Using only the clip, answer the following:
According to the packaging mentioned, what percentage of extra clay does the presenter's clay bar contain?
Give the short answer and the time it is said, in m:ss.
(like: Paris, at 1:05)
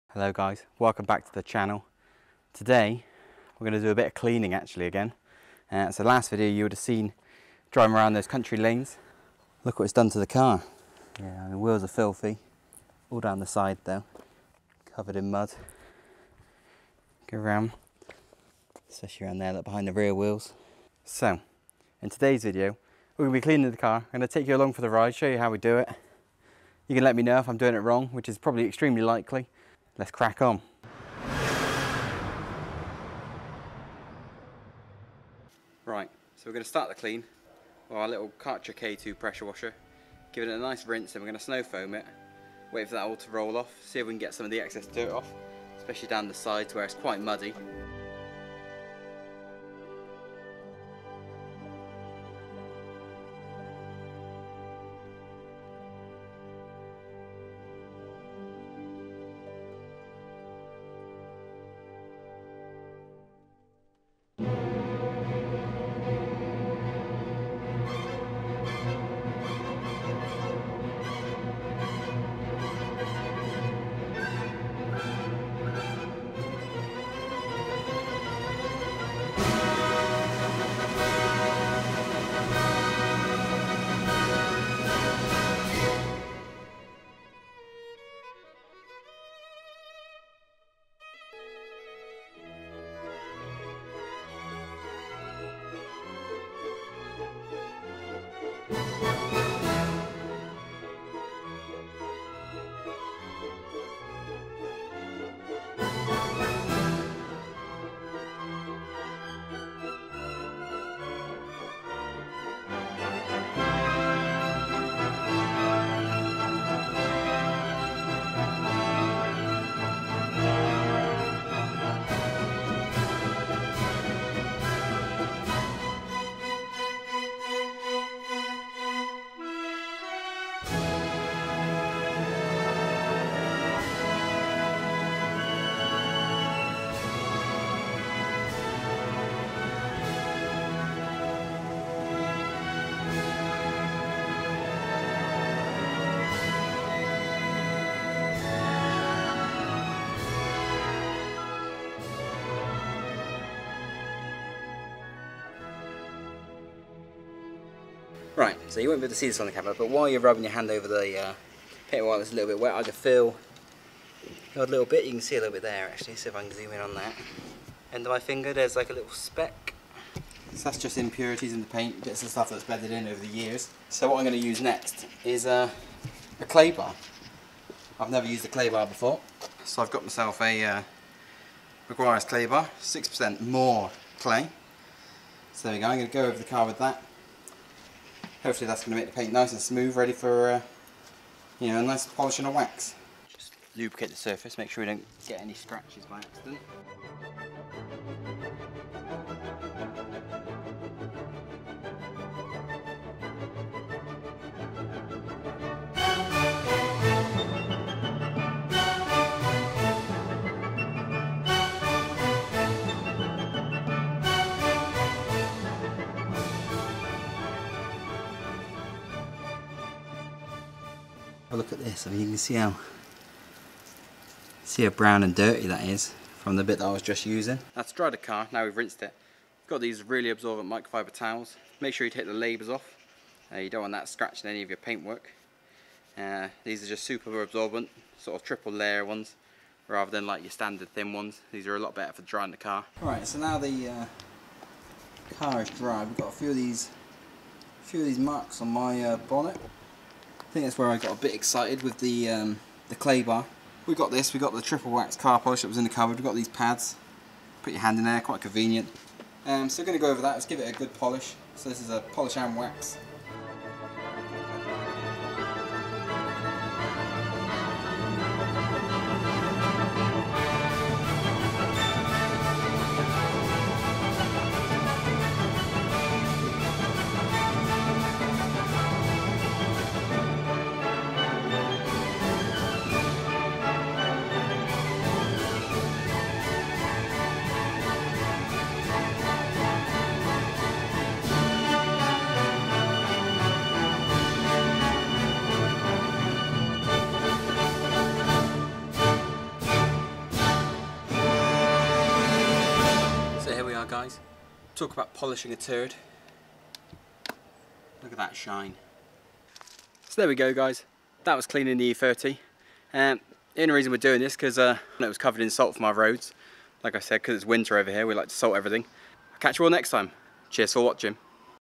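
6%, at 3:02.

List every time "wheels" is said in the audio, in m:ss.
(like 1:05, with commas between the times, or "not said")
0:11, 0:20.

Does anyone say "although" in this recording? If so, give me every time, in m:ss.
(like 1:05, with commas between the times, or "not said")
not said.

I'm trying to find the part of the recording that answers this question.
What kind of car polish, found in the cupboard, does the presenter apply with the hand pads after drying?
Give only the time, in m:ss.
4:14.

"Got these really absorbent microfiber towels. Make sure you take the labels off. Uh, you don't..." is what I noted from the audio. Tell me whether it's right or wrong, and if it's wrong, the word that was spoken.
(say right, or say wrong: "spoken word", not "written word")
right.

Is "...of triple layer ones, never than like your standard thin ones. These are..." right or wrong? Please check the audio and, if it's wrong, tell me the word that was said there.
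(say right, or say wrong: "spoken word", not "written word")
wrong: "rather", not "never".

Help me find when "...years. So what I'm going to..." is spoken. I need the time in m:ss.
2:53.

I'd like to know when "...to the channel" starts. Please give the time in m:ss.
0:01.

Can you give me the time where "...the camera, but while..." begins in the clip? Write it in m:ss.
2:39.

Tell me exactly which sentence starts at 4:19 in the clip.
Um, so we're going to go over that, let's give it a good polish.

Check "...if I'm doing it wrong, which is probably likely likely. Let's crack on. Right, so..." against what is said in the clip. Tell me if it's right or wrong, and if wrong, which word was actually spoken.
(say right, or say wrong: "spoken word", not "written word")
wrong: "extremely", not "likely".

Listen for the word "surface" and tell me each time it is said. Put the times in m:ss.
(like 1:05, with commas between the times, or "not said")
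3:14.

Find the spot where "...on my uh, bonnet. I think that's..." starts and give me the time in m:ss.
4:08.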